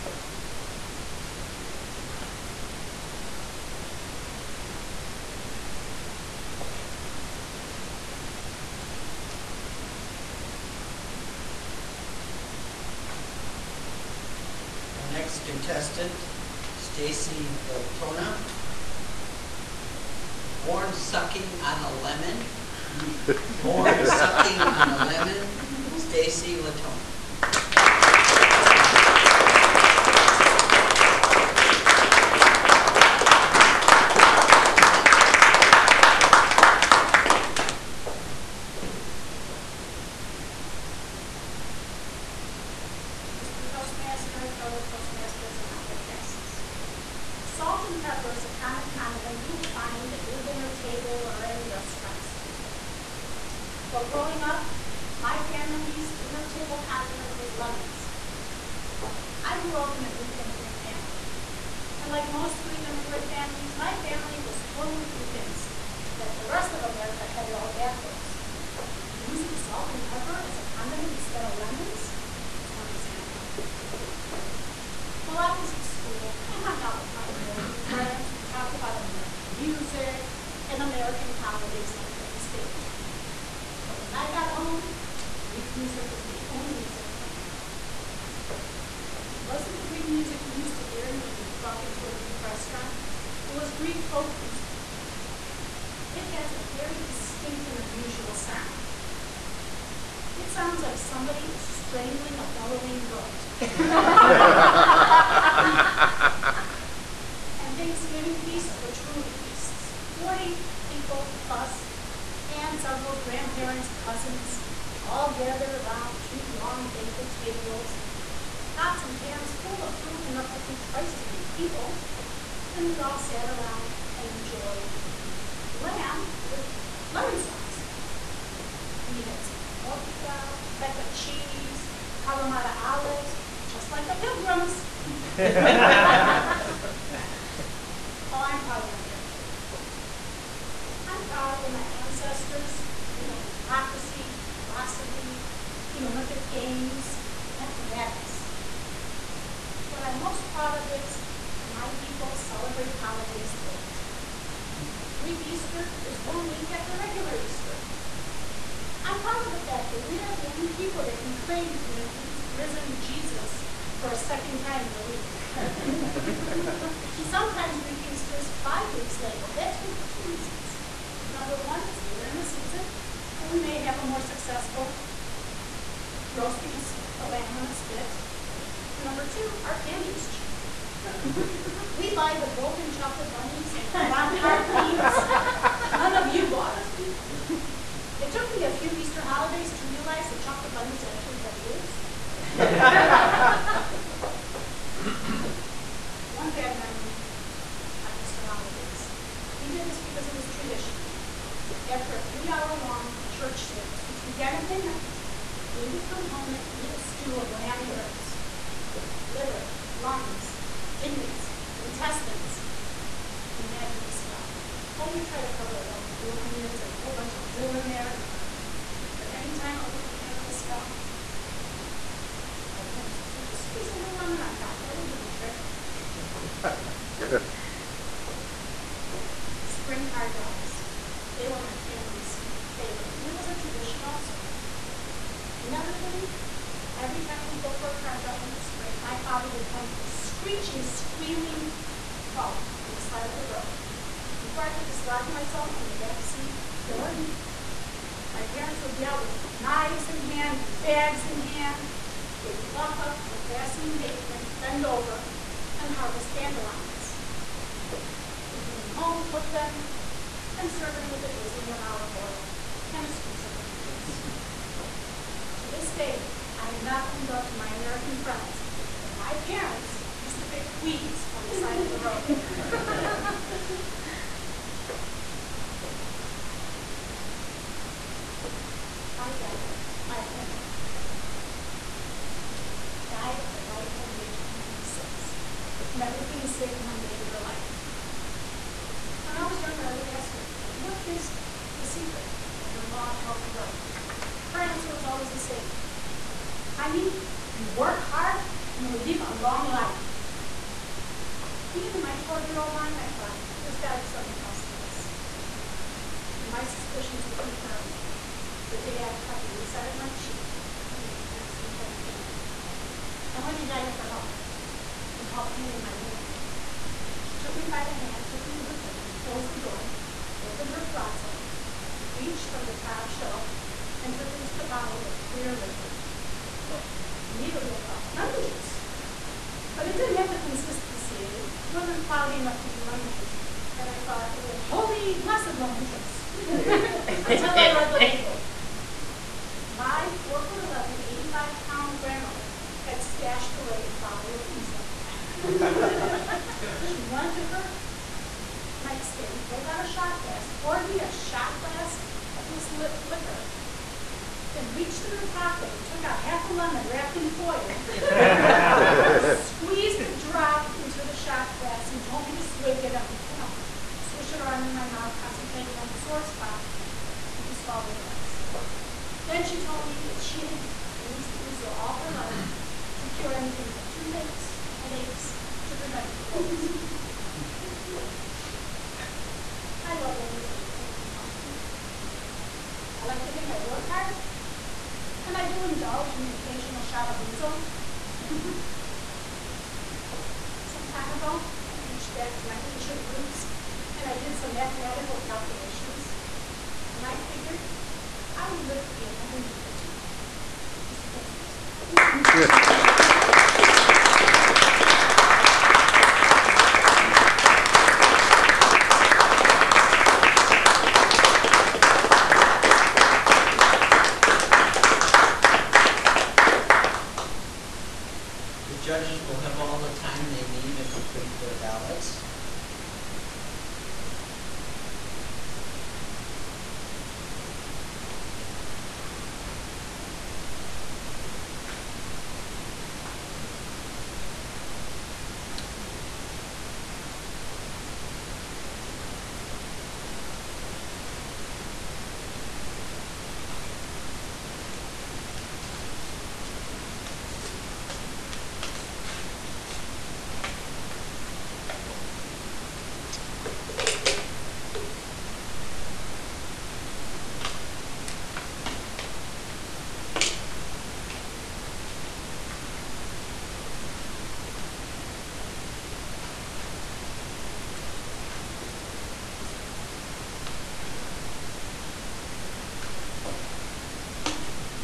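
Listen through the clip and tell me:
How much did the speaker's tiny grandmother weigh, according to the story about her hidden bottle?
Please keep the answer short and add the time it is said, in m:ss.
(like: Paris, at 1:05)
85 pounds, at 5:41.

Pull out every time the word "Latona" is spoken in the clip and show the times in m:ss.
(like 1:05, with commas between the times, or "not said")
0:17, 0:26.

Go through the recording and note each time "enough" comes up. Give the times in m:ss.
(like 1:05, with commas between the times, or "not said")
2:00, 5:32.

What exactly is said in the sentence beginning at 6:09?
Then she told me that she had used ouzo all her life to cure anything from toothaches to headaches to preventing colds.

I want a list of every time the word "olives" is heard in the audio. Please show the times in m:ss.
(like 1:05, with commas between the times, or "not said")
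2:12, 4:21.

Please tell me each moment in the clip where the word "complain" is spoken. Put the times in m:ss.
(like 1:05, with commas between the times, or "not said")
3:40.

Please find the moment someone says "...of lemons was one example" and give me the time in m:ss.
1:11.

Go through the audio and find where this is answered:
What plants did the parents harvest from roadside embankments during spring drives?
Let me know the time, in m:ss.
4:16.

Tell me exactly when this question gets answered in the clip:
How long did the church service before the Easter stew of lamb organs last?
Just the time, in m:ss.
3:22.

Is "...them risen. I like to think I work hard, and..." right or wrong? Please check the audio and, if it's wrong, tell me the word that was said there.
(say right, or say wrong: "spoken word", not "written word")
wrong: "often", not "risen".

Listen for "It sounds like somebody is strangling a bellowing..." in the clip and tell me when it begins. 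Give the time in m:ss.
1:40.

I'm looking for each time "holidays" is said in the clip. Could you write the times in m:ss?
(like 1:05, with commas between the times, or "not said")
1:21, 2:32, 3:09, 3:18.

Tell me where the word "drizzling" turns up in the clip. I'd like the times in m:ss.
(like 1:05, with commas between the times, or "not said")
4:21.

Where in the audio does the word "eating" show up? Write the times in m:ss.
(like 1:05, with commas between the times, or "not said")
2:05, 5:10.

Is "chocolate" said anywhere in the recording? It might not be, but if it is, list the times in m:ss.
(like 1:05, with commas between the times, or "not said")
3:02, 3:10.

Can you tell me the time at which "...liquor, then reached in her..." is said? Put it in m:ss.
5:53.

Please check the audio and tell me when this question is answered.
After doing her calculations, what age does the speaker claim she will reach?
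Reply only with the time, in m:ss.
6:39.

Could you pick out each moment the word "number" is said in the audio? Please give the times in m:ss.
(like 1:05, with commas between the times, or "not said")
2:51, 2:59.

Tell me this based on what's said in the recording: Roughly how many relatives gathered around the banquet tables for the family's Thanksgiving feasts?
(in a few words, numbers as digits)
40.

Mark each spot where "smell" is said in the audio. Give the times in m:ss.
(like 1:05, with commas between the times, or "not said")
3:34, 3:40.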